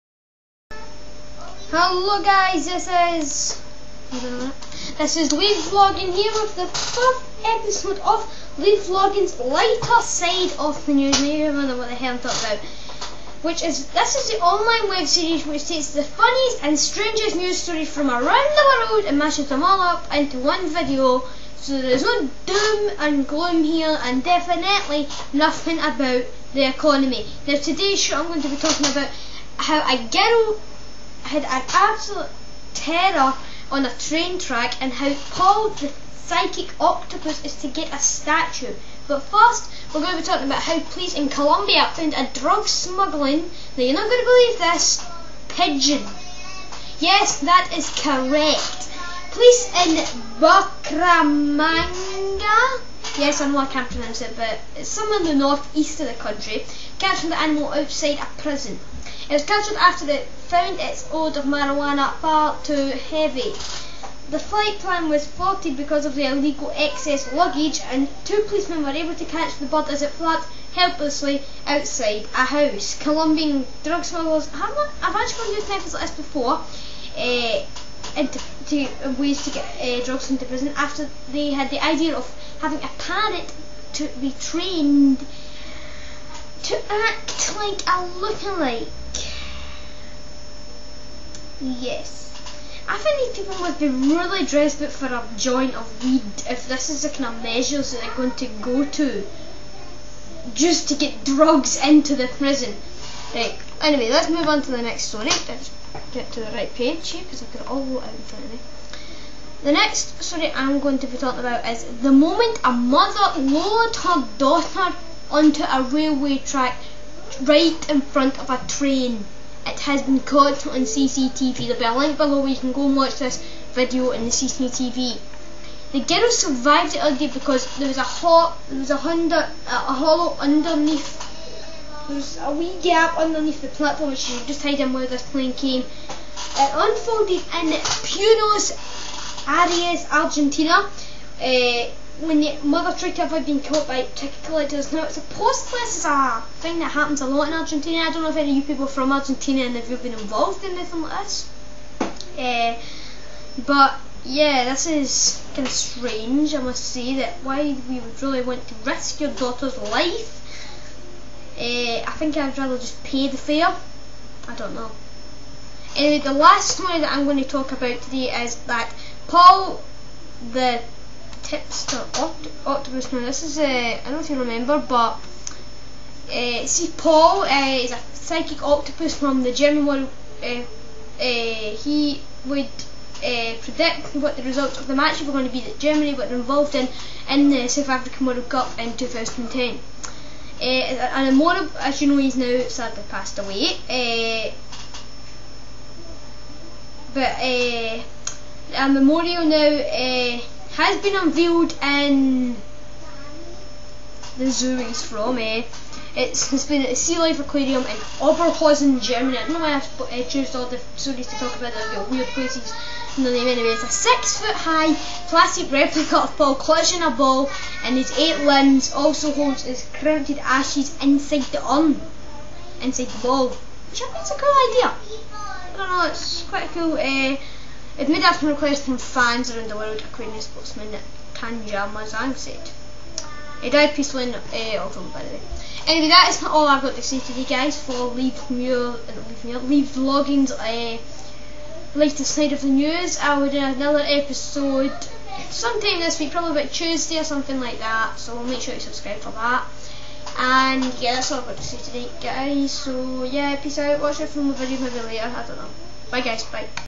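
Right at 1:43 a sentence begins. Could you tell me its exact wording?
Right, anyway, let's move on to the next story.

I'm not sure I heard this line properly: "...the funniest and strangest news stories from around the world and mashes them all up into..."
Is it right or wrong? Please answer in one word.
right.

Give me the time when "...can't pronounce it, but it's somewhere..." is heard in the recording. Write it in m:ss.
0:53.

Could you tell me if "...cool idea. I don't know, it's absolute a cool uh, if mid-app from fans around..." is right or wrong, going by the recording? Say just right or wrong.
wrong.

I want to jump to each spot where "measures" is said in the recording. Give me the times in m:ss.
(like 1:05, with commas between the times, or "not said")
1:37.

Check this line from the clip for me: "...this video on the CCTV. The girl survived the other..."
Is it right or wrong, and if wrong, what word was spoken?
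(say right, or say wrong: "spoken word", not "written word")
right.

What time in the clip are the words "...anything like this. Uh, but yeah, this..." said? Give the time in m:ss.
2:30.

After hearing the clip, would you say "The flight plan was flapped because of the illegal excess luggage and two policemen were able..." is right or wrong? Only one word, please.
wrong.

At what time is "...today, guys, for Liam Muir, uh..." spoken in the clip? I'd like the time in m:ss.
3:57.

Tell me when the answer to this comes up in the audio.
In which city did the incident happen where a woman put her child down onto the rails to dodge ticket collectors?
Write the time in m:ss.
2:17.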